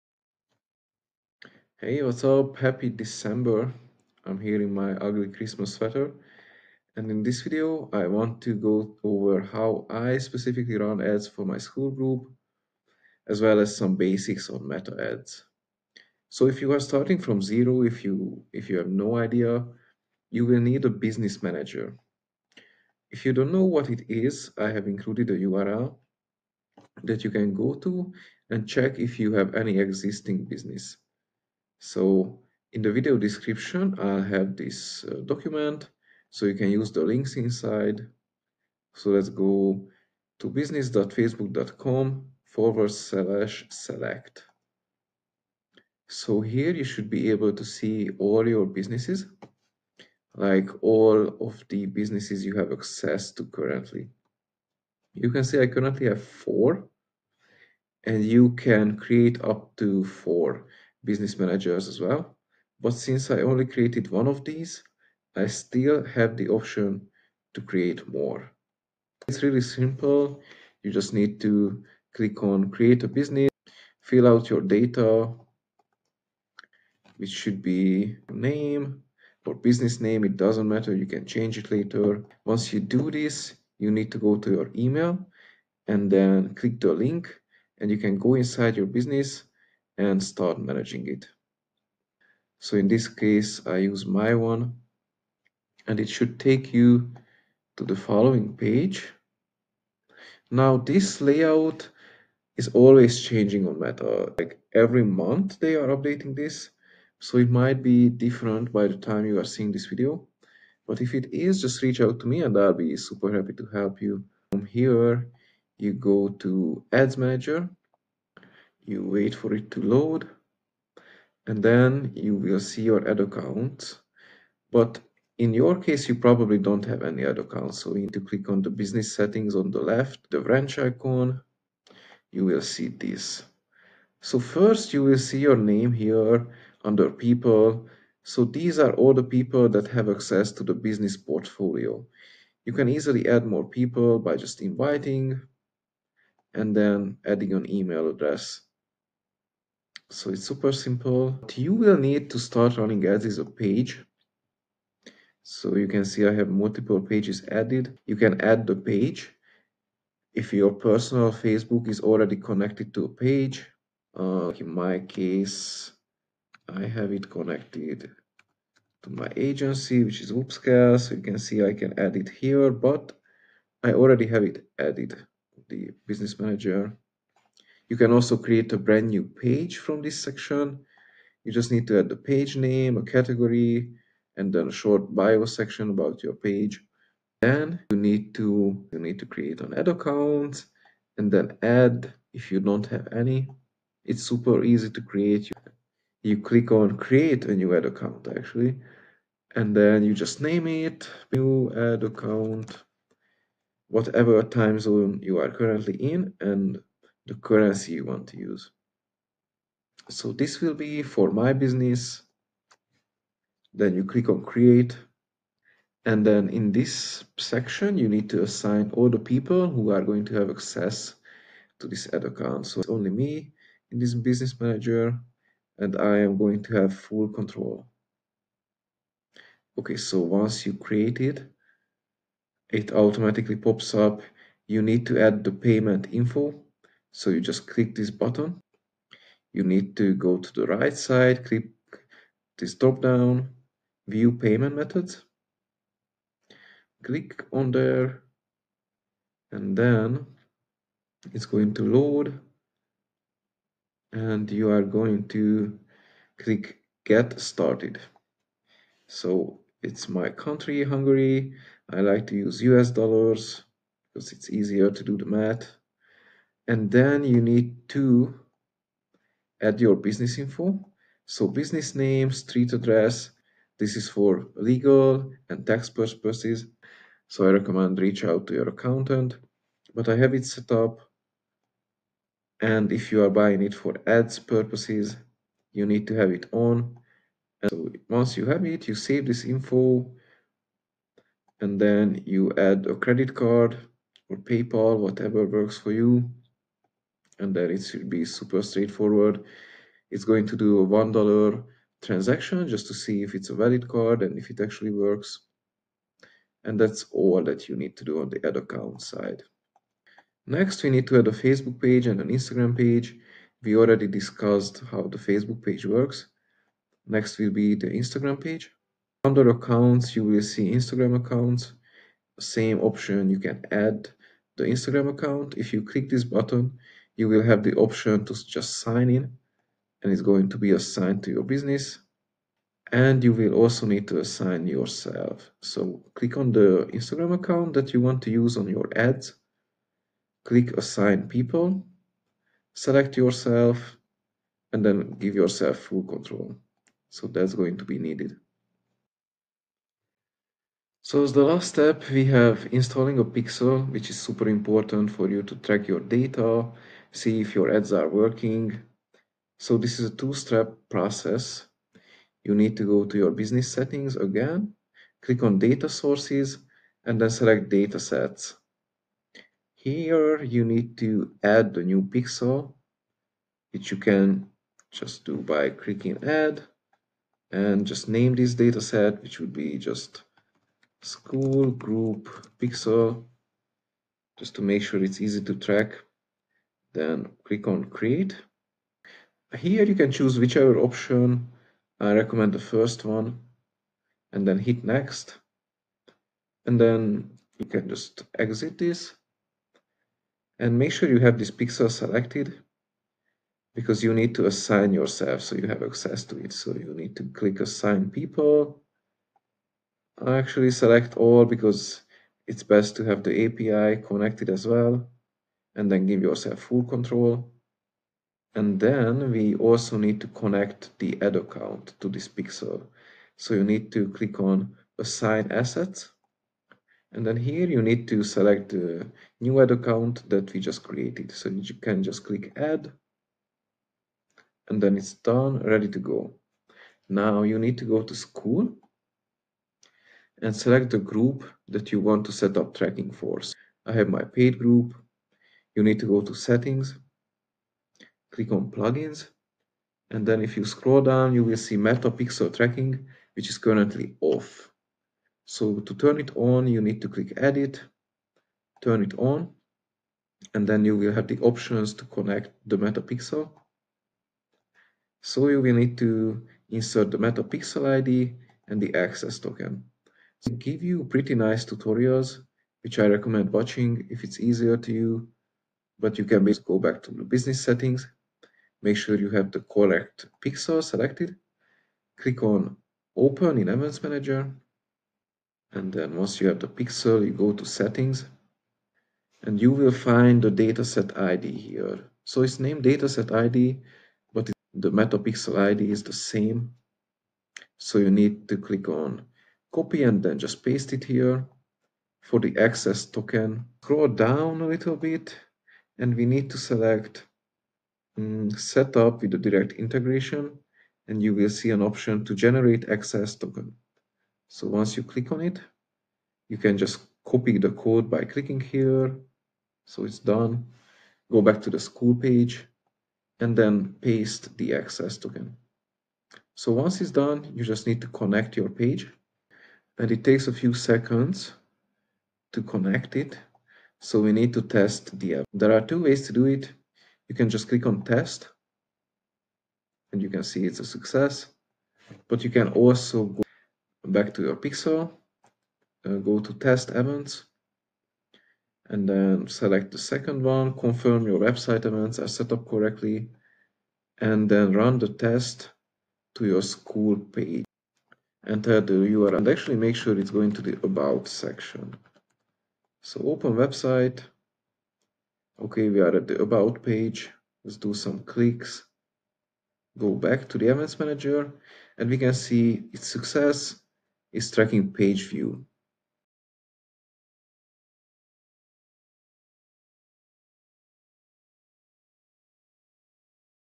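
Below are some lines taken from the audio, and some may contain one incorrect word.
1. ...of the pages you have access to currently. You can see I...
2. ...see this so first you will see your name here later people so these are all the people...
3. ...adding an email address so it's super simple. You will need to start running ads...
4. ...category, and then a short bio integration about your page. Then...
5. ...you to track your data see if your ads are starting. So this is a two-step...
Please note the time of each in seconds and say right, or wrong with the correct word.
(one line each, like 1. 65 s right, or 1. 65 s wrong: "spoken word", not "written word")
1. 51 s wrong: "businesses", not "pages"
2. 132 s wrong: "under", not "later"
3. 147 s right
4. 183 s wrong: "section", not "integration"
5. 355 s wrong: "working", not "starting".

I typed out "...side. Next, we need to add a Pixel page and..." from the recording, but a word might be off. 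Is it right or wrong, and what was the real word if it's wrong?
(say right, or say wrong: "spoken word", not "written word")
wrong: "Facebook", not "Pixel".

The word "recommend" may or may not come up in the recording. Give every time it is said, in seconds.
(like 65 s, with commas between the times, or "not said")
277 s, 392 s, 473 s.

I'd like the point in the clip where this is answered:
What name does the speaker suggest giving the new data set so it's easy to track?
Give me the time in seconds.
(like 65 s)
381 s.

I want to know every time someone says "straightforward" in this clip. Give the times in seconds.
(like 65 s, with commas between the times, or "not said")
298 s.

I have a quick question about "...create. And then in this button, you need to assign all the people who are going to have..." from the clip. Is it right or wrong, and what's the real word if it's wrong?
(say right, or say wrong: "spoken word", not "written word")
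wrong: "section", not "button".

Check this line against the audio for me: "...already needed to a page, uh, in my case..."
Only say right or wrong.
wrong.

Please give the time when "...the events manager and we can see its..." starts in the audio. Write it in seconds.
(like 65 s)
570 s.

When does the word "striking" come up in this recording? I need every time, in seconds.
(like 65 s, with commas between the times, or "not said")
not said.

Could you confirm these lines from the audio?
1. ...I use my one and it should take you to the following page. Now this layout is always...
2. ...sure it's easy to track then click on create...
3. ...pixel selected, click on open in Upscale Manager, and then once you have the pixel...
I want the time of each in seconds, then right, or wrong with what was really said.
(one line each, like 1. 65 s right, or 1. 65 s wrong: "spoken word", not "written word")
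1. 93 s right
2. 384 s right
3. 480 s wrong: "Events", not "Upscale".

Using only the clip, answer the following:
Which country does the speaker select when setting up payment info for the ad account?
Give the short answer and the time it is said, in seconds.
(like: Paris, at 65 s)
Hungary, at 260 s.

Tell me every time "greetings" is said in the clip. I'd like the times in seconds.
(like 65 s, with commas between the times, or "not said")
not said.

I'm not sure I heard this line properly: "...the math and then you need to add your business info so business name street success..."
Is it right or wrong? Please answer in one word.
wrong.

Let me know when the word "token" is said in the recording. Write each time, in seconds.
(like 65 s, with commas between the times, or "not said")
469 s, 503 s, 513 s, 525 s.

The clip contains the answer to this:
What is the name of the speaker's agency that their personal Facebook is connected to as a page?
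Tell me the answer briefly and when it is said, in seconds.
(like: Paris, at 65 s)
Upscale, at 170 s.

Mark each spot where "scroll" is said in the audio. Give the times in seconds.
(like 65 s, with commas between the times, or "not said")
450 s, 503 s.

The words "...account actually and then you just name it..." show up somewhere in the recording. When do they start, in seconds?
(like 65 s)
197 s.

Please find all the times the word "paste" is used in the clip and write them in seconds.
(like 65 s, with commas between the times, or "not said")
500 s, 524 s.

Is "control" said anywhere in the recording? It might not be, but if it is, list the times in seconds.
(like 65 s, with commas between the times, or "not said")
227 s, 346 s, 416 s.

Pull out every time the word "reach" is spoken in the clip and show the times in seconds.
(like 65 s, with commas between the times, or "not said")
111 s, 277 s.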